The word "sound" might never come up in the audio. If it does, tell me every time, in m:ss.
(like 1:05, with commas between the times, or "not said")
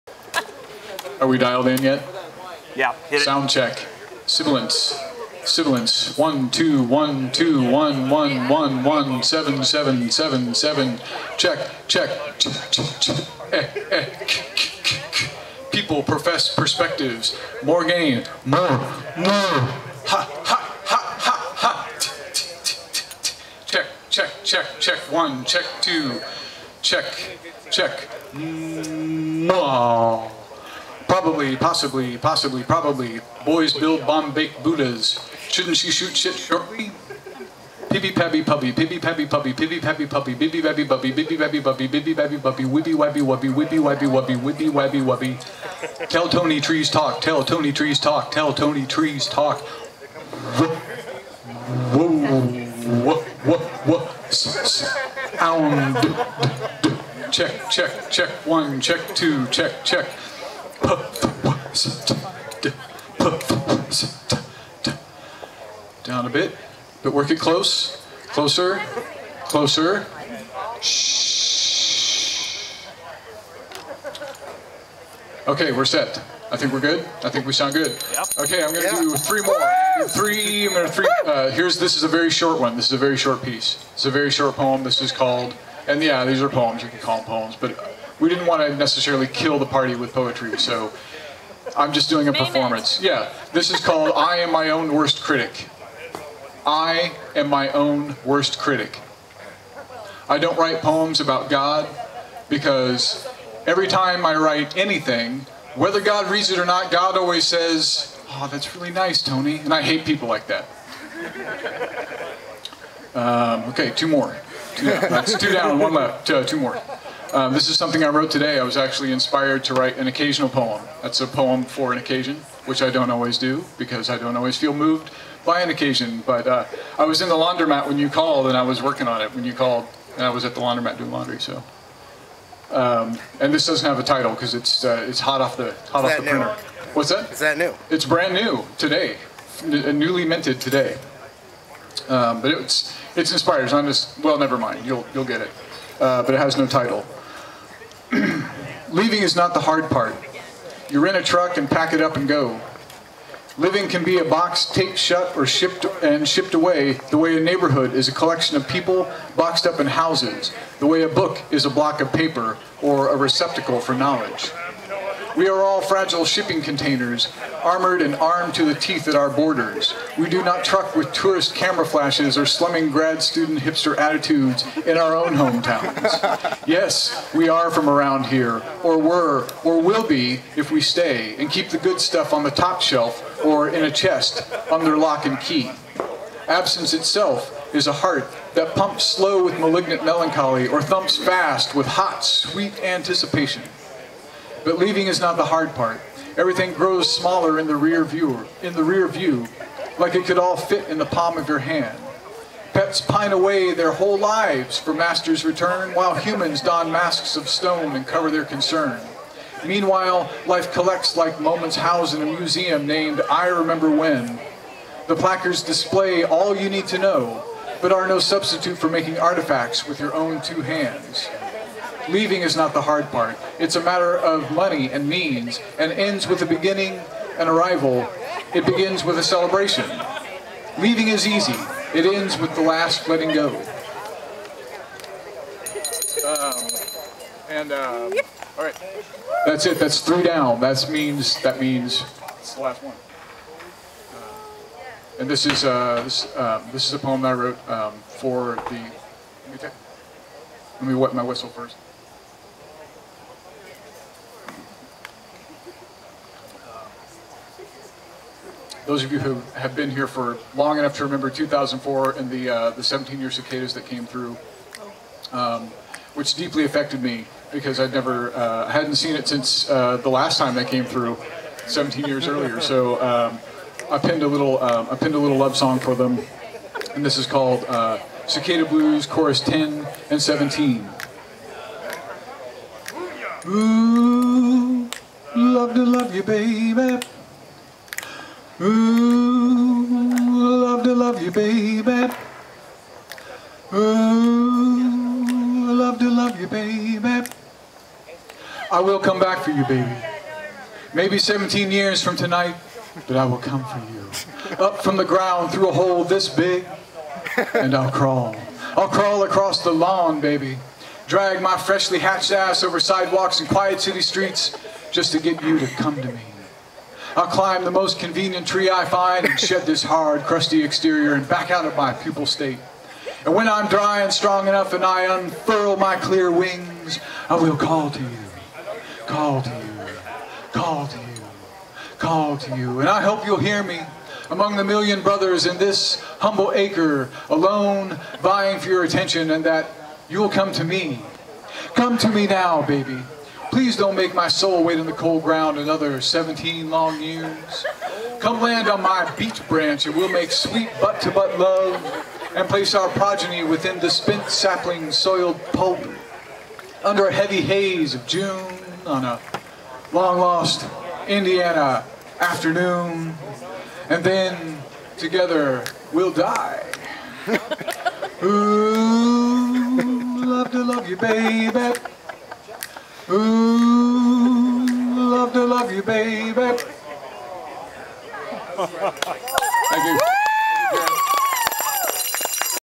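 0:03, 0:54, 1:17.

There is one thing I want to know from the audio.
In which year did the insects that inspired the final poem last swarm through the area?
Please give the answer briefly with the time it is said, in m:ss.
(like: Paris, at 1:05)
2004, at 4:21.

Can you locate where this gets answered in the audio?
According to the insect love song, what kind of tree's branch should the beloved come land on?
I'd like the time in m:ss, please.
5:49.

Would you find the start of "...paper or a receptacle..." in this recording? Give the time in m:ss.
2:42.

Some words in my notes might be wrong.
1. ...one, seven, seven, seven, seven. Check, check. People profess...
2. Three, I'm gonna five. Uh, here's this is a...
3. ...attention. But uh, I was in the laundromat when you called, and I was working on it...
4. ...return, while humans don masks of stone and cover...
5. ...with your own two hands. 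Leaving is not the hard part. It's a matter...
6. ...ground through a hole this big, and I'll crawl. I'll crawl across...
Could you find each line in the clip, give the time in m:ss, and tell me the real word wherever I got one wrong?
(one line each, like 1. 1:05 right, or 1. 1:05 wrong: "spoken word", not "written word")
1. 0:08 right
2. 1:20 wrong: "three", not "five"
3. 2:05 wrong: "occasion", not "attention"
4. 3:25 right
5. 3:39 right
6. 5:05 right.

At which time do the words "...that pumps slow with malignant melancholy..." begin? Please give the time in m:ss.
3:08.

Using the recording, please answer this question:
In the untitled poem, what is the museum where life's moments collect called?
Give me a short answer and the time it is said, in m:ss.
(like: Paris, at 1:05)
I Remember When, at 3:33.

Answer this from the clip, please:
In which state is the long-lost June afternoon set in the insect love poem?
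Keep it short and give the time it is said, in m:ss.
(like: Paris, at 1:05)
Indiana, at 6:01.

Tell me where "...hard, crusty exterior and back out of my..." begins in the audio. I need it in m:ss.
5:19.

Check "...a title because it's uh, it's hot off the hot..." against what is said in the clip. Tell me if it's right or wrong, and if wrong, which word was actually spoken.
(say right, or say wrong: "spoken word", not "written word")
right.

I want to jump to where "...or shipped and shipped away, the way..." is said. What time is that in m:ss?
2:35.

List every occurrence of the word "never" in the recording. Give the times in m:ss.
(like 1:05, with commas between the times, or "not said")
2:24, 4:27.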